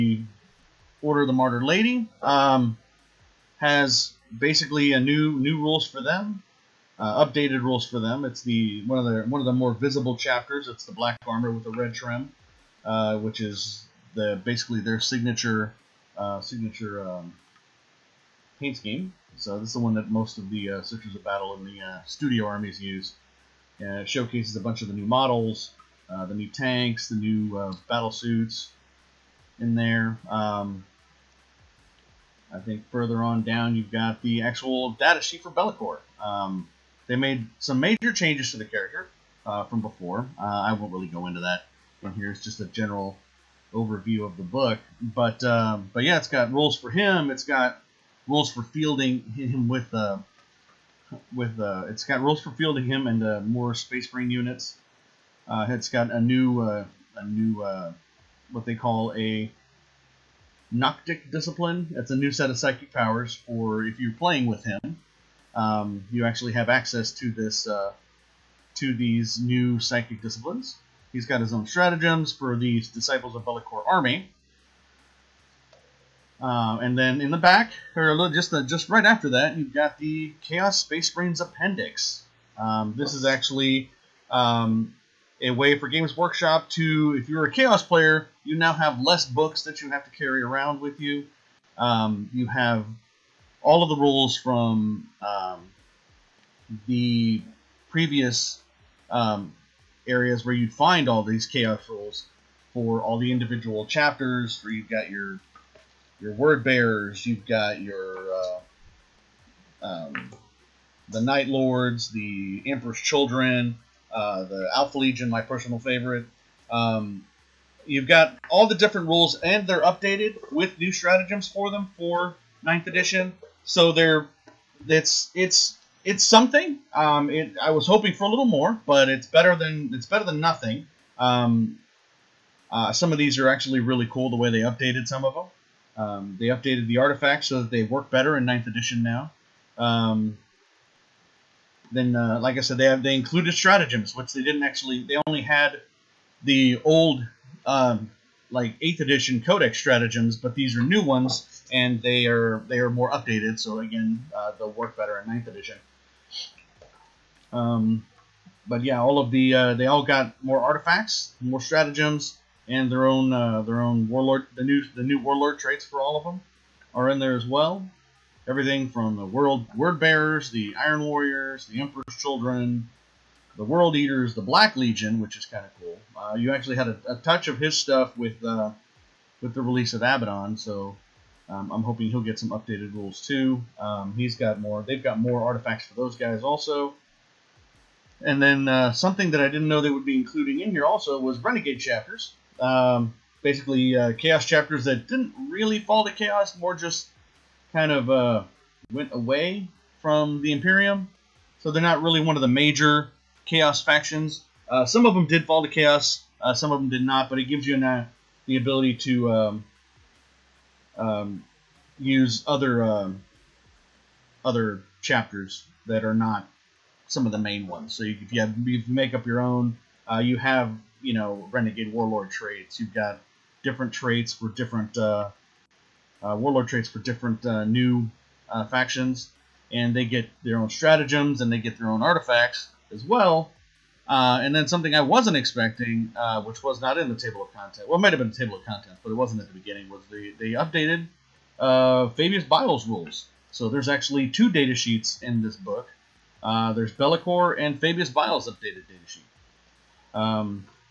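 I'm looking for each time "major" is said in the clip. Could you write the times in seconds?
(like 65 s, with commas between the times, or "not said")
37 s, 202 s.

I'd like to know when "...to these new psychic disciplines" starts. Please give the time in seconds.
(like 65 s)
68 s.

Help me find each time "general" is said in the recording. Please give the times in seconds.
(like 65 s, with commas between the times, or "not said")
42 s.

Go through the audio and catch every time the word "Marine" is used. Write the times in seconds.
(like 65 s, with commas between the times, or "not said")
54 s, 81 s.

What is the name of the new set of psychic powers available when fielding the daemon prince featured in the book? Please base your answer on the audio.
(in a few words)
Noctic Discipline.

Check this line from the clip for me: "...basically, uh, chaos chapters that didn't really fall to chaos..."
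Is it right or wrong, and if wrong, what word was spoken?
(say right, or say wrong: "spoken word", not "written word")
right.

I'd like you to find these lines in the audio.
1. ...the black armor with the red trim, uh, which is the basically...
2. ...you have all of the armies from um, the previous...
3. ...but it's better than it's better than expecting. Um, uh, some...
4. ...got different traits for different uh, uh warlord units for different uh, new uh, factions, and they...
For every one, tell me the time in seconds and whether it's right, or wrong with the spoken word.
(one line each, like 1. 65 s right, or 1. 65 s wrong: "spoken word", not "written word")
1. 10 s right
2. 92 s wrong: "rules", not "armies"
3. 128 s wrong: "nothing", not "expecting"
4. 222 s wrong: "traits", not "units".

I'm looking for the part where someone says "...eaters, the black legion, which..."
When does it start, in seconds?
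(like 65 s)
173 s.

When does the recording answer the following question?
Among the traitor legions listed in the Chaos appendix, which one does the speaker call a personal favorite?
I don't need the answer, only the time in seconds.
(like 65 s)
114 s.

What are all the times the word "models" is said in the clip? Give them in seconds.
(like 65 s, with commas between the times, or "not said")
25 s.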